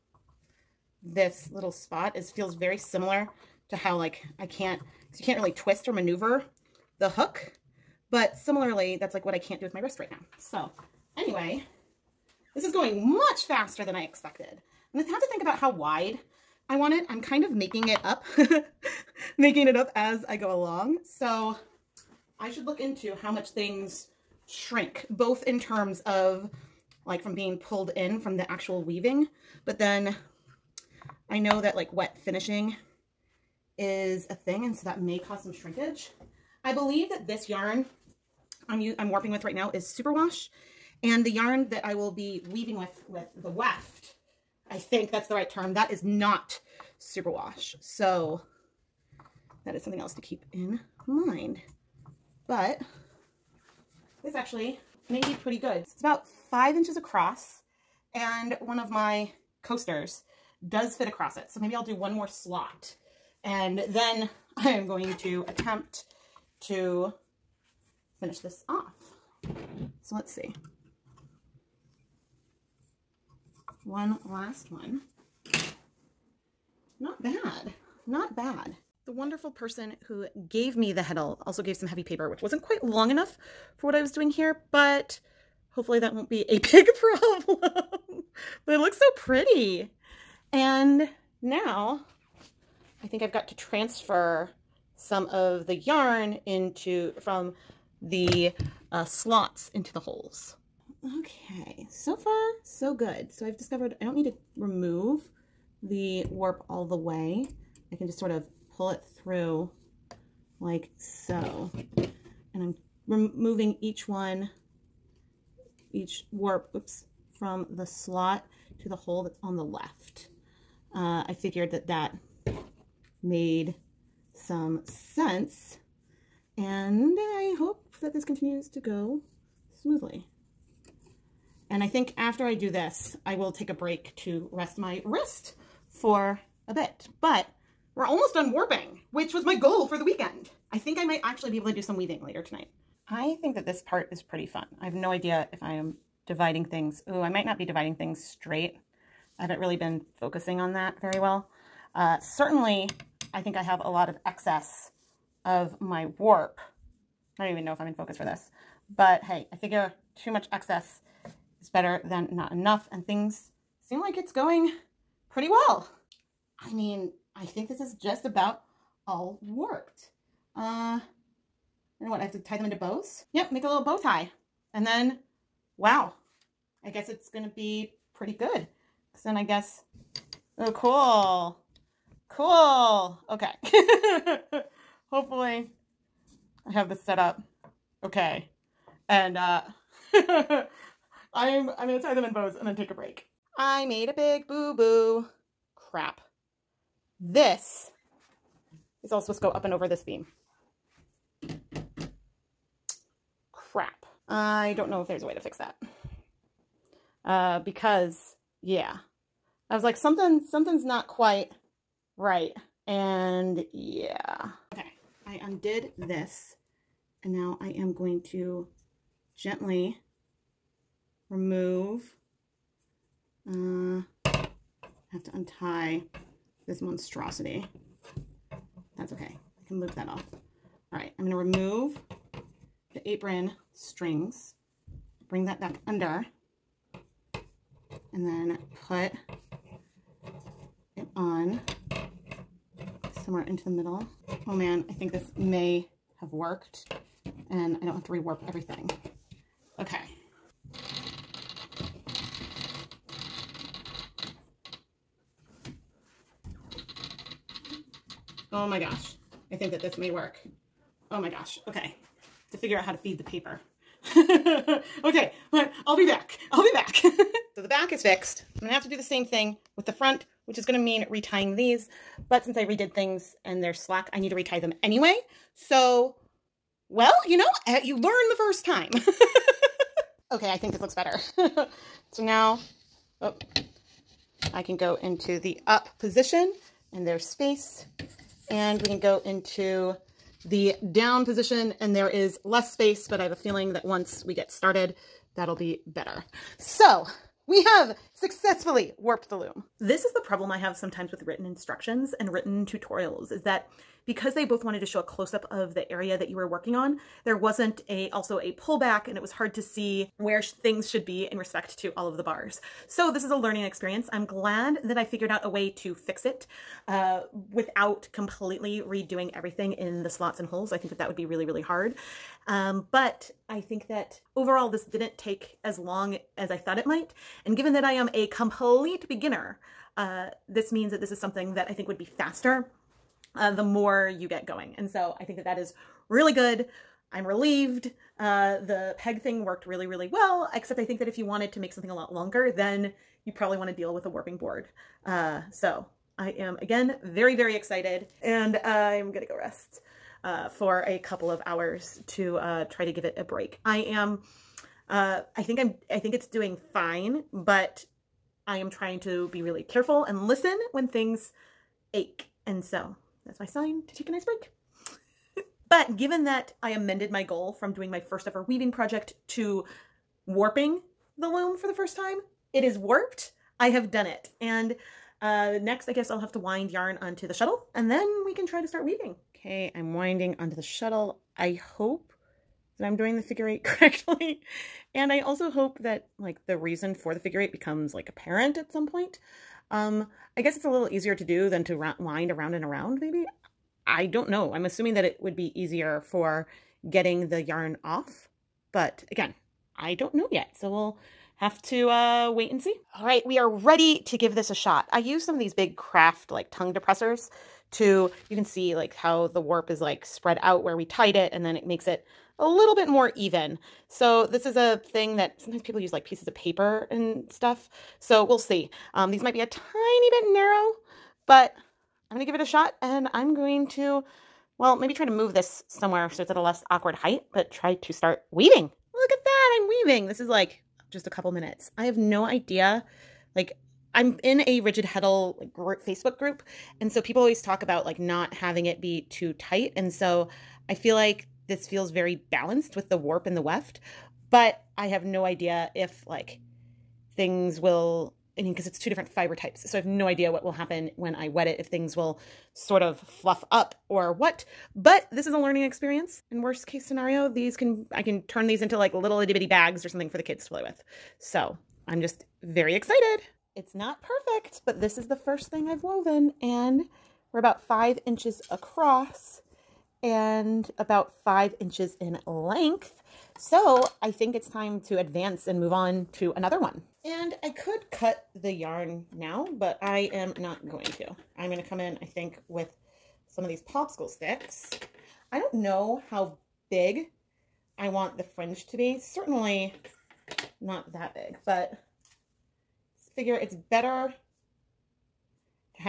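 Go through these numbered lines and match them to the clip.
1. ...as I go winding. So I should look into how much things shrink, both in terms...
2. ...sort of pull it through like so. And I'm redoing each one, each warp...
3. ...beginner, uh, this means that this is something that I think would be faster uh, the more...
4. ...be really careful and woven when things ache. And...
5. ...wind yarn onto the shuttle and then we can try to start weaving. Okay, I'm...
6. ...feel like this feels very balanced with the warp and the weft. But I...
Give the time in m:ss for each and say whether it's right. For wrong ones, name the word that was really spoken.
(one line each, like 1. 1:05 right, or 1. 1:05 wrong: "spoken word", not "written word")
1. 0:19 wrong: "along", not "winding"
2. 1:48 wrong: "removing", not "redoing"
3. 5:29 right
4. 5:59 wrong: "listen", not "woven"
5. 6:16 right
6. 7:20 right.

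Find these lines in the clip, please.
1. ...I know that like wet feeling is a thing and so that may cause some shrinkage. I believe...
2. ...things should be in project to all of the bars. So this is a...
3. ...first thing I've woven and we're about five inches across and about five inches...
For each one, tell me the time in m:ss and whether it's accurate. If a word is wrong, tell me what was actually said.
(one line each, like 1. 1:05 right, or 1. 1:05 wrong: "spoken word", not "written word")
1. 0:31 wrong: "finishing", not "feeling"
2. 5:10 wrong: "respect", not "project"
3. 7:45 right.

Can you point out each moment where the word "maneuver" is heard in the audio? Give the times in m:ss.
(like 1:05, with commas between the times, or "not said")
0:05.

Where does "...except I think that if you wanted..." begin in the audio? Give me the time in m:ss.
5:40.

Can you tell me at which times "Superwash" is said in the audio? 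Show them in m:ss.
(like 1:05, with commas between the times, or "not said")
0:39, 0:46.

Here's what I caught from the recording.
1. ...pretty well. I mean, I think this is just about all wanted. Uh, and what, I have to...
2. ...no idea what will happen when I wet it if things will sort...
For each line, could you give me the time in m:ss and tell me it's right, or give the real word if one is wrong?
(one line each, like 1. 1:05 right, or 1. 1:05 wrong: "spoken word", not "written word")
1. 2:45 wrong: "worked", not "wanted"
2. 7:29 right.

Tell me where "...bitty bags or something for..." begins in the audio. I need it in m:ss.
7:39.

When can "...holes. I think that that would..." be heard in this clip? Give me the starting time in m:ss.
5:20.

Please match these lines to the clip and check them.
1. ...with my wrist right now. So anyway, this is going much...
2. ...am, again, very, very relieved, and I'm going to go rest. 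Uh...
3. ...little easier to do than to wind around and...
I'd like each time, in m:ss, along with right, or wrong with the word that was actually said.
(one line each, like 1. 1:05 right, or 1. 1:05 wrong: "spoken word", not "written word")
1. 0:09 right
2. 5:46 wrong: "excited", not "relieved"
3. 6:30 right.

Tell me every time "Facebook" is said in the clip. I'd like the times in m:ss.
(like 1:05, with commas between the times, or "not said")
7:15.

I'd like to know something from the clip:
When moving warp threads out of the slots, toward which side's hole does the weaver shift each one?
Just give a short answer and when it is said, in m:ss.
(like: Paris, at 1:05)
the left, at 1:59.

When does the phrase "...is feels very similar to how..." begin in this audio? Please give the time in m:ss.
0:02.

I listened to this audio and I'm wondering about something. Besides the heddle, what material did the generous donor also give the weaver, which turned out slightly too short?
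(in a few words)
heavy paper.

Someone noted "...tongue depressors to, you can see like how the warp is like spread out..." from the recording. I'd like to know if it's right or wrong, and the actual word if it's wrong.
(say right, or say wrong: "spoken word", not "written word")
right.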